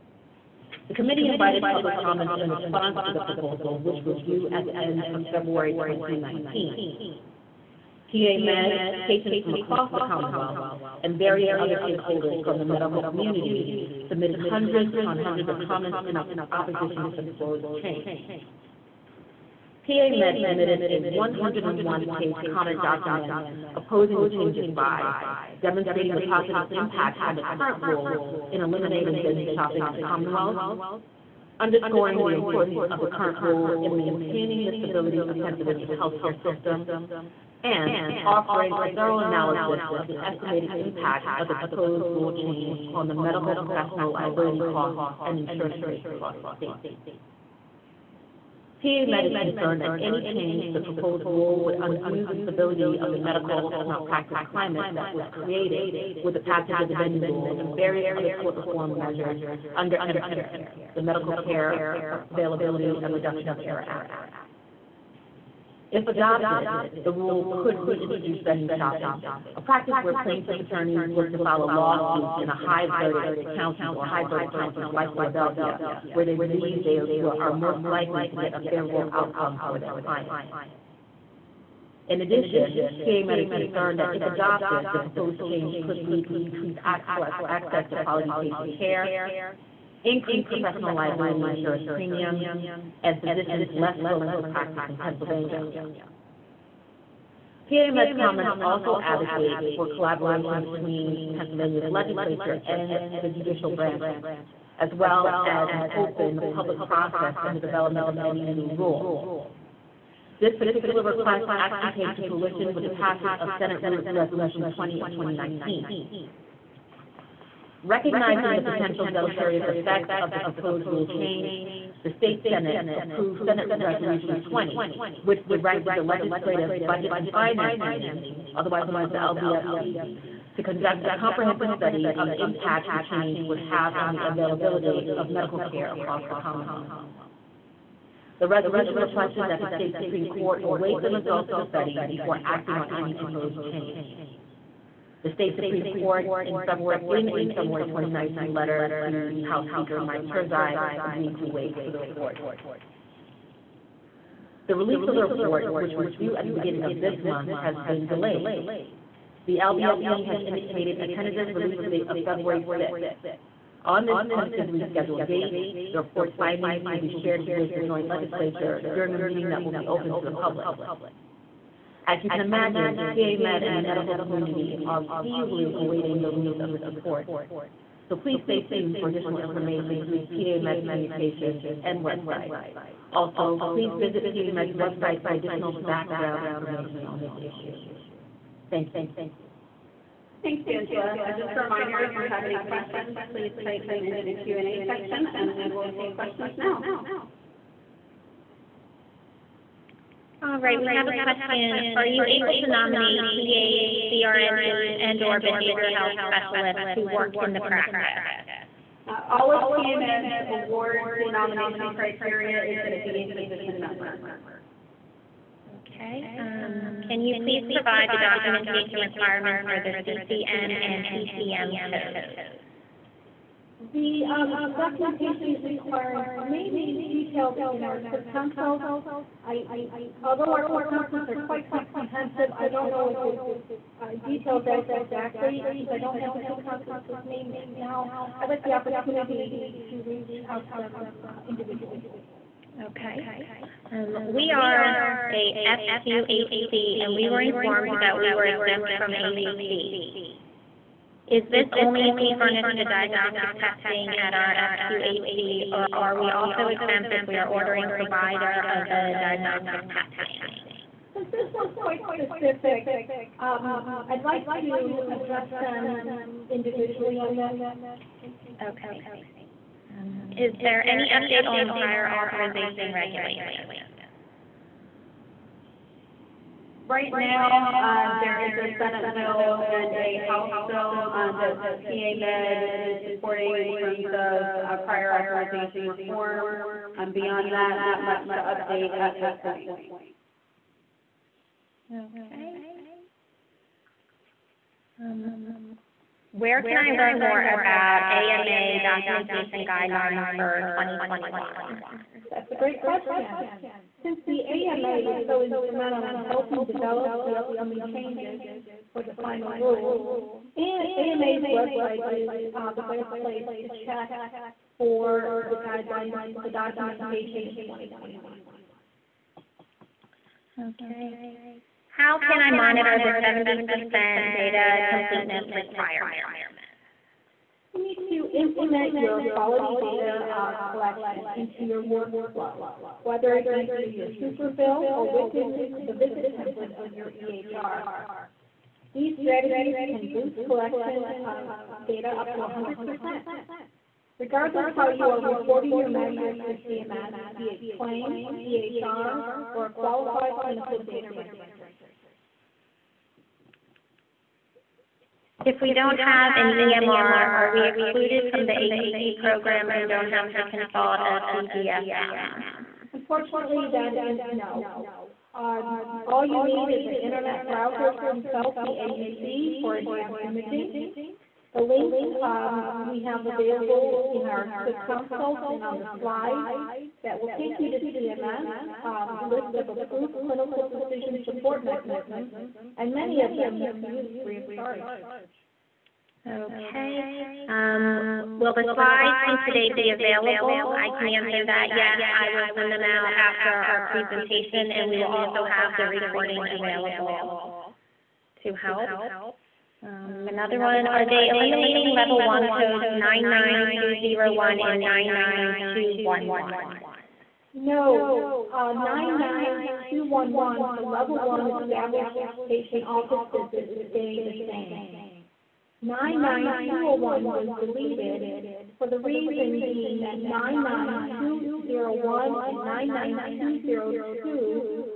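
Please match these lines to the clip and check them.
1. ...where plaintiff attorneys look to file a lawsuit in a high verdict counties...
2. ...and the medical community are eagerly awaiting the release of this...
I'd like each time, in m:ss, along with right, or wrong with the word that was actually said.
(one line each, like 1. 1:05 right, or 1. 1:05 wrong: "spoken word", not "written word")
1. 1:10 right
2. 2:53 right.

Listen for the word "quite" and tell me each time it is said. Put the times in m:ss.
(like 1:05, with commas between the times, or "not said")
3:51, 4:21.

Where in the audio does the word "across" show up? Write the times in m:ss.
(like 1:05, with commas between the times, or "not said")
0:09, 0:46, 2:15.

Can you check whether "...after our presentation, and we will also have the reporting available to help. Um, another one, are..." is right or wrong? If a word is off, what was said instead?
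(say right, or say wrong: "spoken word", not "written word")
wrong: "recording", not "reporting".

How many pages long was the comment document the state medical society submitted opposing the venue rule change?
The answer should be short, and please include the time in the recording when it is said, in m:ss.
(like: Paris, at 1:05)
101, at 0:21.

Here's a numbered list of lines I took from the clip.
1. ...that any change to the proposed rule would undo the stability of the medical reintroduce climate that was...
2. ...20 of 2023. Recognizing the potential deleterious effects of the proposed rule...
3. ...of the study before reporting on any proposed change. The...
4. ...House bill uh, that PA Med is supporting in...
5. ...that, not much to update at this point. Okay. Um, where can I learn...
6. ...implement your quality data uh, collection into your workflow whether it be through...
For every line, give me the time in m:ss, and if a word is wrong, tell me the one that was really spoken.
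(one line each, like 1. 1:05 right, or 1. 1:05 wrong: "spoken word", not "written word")
1. 0:49 wrong: "malpractice", not "reintroduce"
2. 1:54 wrong: "2019", not "2023"
3. 2:21 wrong: "acting", not "reporting"
4. 4:40 right
5. 4:47 right
6. 5:28 right.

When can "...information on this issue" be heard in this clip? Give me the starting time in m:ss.
3:06.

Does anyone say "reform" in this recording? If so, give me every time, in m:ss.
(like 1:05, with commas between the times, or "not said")
0:58, 4:45.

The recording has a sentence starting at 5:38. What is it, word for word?
These strategies can boost collection data up to 100%.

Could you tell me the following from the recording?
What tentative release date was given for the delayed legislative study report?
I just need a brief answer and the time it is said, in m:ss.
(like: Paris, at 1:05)
February 5th, at 2:42.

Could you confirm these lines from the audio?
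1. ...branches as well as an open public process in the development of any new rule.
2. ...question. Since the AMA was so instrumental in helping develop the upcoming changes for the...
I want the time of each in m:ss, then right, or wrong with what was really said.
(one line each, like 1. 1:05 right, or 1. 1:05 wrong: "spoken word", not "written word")
1. 1:43 right
2. 5:02 right.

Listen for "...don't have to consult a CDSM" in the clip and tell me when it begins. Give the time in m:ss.
5:59.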